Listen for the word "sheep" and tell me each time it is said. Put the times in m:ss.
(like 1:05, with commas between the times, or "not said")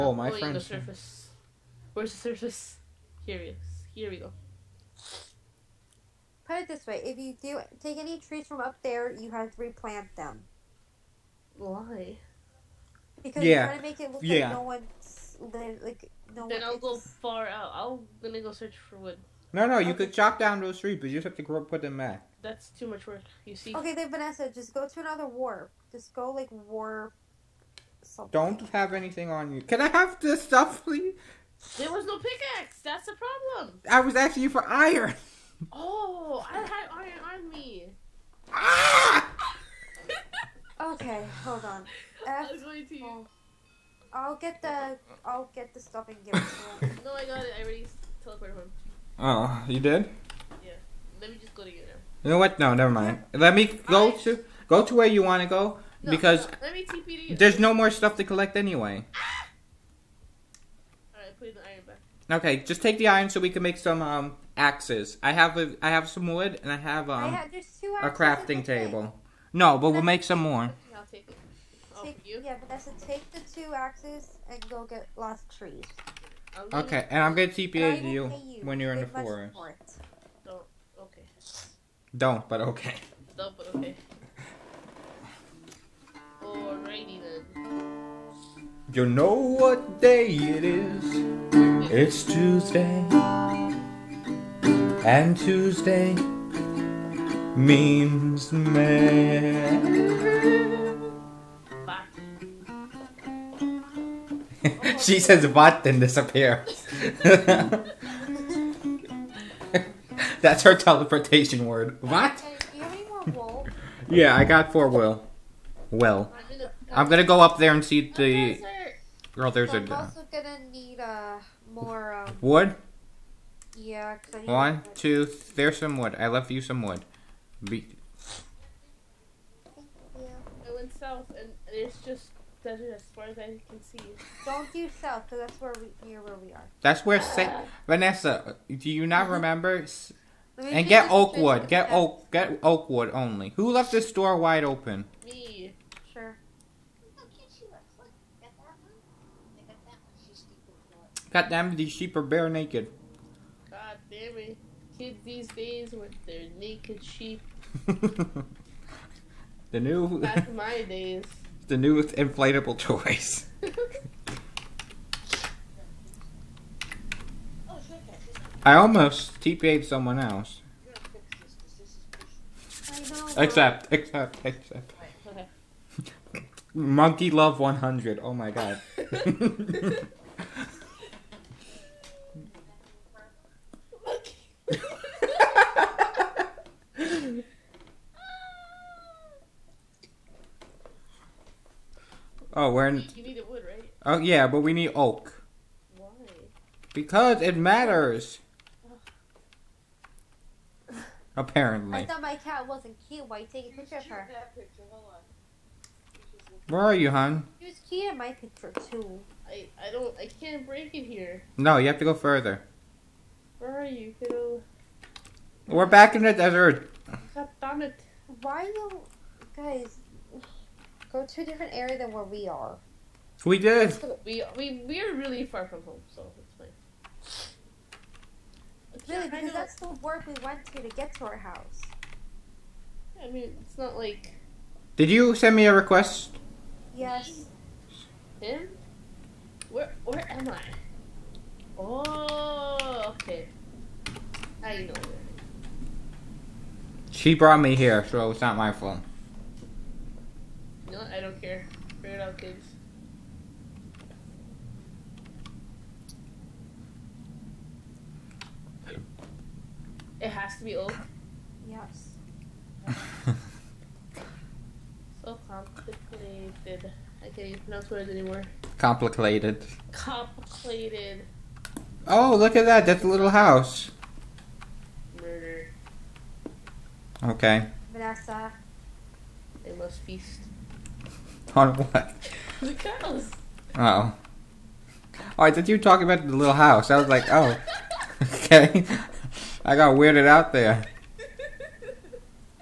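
2:31, 2:37.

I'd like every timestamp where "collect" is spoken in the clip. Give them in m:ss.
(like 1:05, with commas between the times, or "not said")
0:58.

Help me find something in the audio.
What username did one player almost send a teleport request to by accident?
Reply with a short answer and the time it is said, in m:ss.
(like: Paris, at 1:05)
Monkey Love 100, at 2:56.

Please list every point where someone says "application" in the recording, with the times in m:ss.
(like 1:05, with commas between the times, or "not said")
not said.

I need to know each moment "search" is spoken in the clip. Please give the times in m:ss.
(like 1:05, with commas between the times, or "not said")
0:18.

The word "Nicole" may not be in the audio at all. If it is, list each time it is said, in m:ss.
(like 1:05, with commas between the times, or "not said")
not said.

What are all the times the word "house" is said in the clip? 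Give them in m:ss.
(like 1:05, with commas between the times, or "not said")
3:51, 4:33, 4:46.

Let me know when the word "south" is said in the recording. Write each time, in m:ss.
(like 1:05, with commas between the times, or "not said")
2:10, 2:15.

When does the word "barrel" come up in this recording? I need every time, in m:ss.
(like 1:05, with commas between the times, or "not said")
not said.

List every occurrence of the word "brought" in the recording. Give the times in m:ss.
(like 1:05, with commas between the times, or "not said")
4:07.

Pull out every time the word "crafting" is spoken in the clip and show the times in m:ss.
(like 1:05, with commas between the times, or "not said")
1:08.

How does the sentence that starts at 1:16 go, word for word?
Okay, and I'm gonna TPA you, you when you're in the forest.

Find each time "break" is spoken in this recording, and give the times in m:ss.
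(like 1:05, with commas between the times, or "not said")
3:30.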